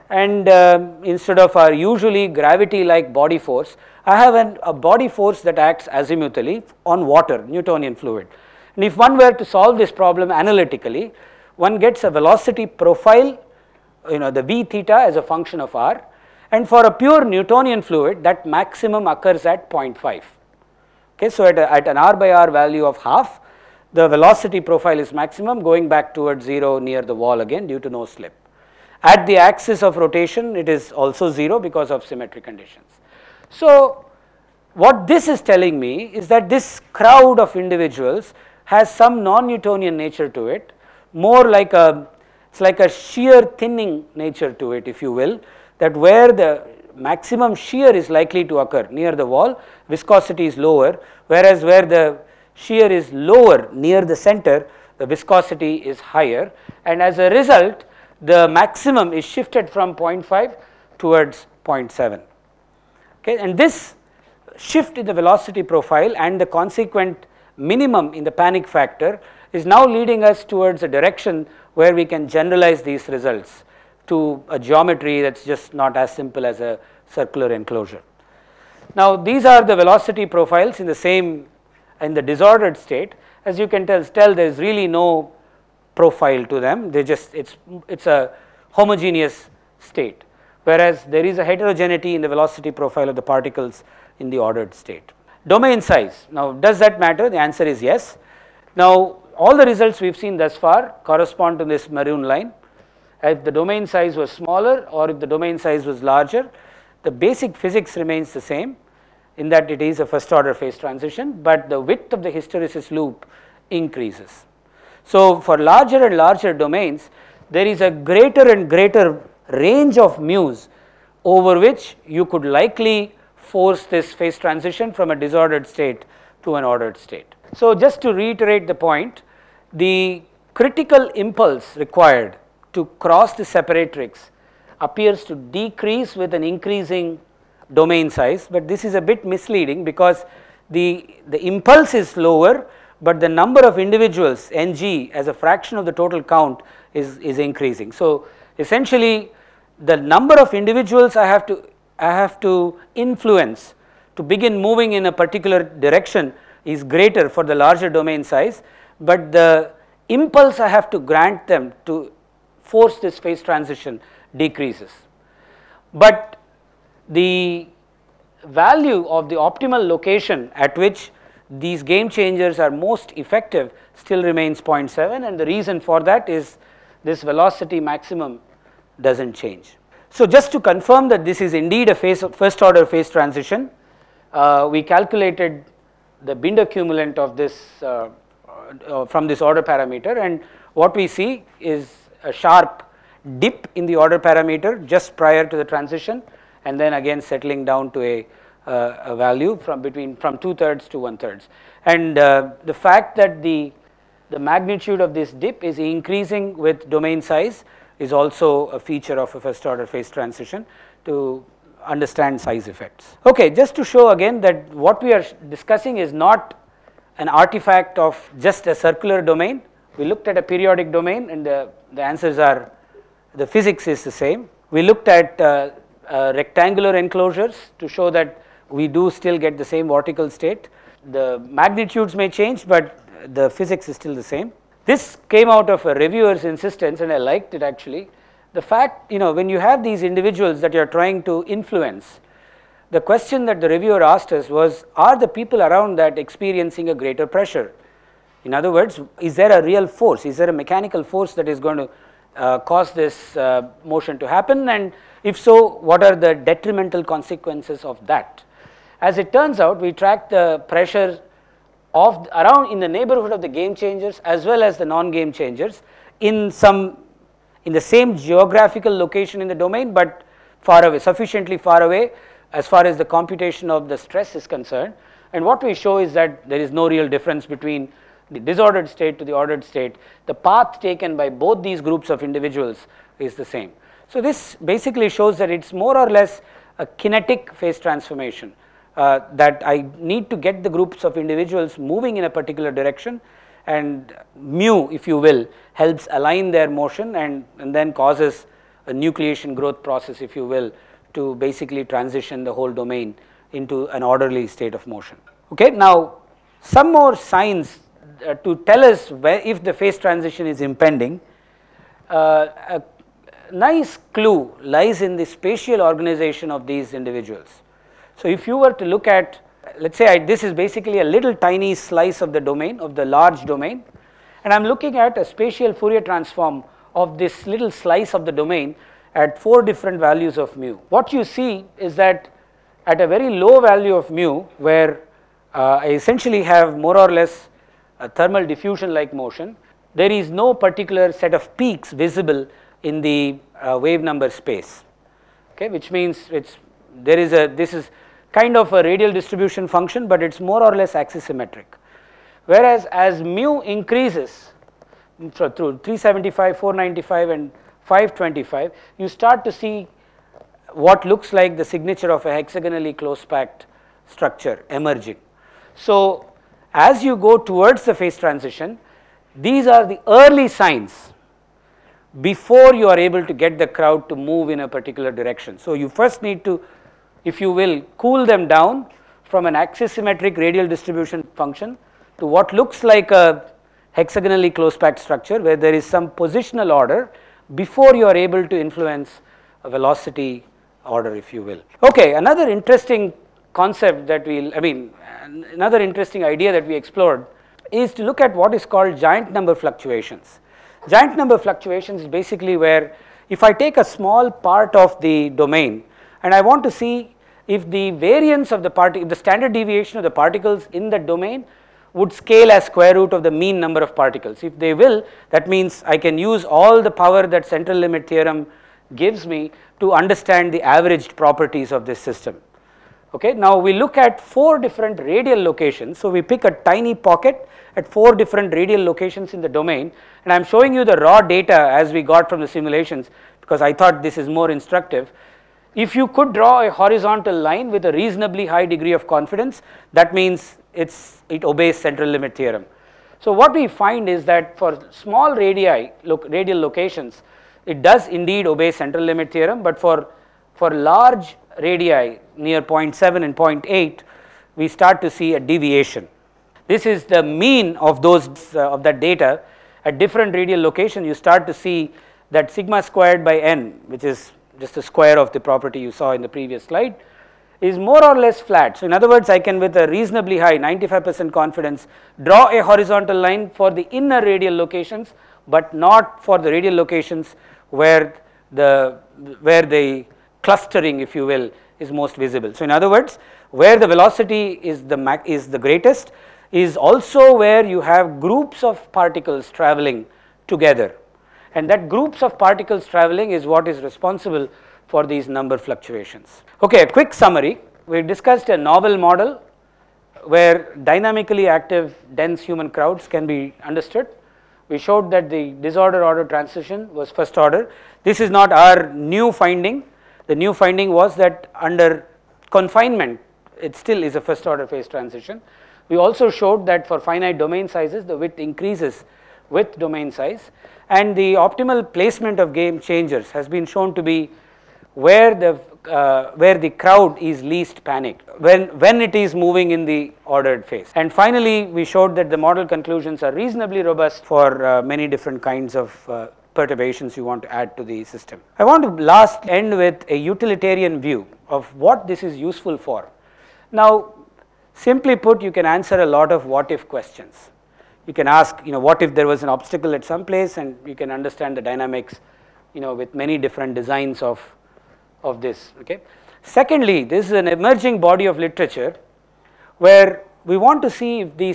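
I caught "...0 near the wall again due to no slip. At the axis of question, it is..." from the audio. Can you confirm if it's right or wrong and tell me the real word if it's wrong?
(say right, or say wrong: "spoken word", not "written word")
wrong: "rotation", not "question".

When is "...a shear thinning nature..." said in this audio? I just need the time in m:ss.
0:42.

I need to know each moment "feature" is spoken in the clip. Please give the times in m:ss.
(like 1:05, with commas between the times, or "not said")
3:28.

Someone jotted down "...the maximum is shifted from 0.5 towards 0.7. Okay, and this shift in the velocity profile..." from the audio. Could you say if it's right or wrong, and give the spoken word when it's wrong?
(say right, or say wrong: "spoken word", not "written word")
right.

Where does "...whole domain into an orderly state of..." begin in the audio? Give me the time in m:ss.
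5:02.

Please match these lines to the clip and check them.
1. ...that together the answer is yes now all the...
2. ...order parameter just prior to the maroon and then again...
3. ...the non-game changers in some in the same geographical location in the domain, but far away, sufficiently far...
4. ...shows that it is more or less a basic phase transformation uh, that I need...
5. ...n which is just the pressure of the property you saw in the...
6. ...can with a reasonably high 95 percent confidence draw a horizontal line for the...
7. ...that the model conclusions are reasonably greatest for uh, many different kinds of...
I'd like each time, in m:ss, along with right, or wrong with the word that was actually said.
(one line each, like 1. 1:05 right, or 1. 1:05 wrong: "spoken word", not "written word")
1. 1:36 wrong: "matter", not "together"
2. 3:13 wrong: "transition", not "maroon"
3. 4:24 right
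4. 4:45 wrong: "kinetic", not "basic"
5. 7:43 wrong: "square", not "pressure"
6. 7:49 right
7. 8:52 wrong: "robust", not "greatest".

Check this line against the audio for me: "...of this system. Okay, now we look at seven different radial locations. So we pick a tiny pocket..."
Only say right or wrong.
wrong.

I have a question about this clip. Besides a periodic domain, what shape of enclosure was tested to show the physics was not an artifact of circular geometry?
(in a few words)
Rectangular.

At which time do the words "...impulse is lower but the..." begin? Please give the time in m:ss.
2:21.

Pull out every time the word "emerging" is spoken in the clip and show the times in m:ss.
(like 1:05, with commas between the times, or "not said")
6:04, 9:17.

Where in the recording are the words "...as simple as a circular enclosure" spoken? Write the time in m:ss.
1:15.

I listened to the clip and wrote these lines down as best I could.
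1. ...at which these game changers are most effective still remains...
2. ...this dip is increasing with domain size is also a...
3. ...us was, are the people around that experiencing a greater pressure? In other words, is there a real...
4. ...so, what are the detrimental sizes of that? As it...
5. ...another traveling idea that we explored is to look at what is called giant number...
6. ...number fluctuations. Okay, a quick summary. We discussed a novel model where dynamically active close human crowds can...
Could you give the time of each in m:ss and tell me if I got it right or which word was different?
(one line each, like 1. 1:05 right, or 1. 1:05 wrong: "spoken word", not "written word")
1. 2:50 right
2. 3:25 right
3. 4:04 right
4. 4:15 wrong: "consequences", not "sizes"
5. 6:35 wrong: "interesting", not "traveling"
6. 8:15 wrong: "dense", not "close".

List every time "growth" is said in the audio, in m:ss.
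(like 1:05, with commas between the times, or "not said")
4:59.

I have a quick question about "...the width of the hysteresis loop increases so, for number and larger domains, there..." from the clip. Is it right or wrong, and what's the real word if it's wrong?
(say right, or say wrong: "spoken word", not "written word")
wrong: "larger", not "number".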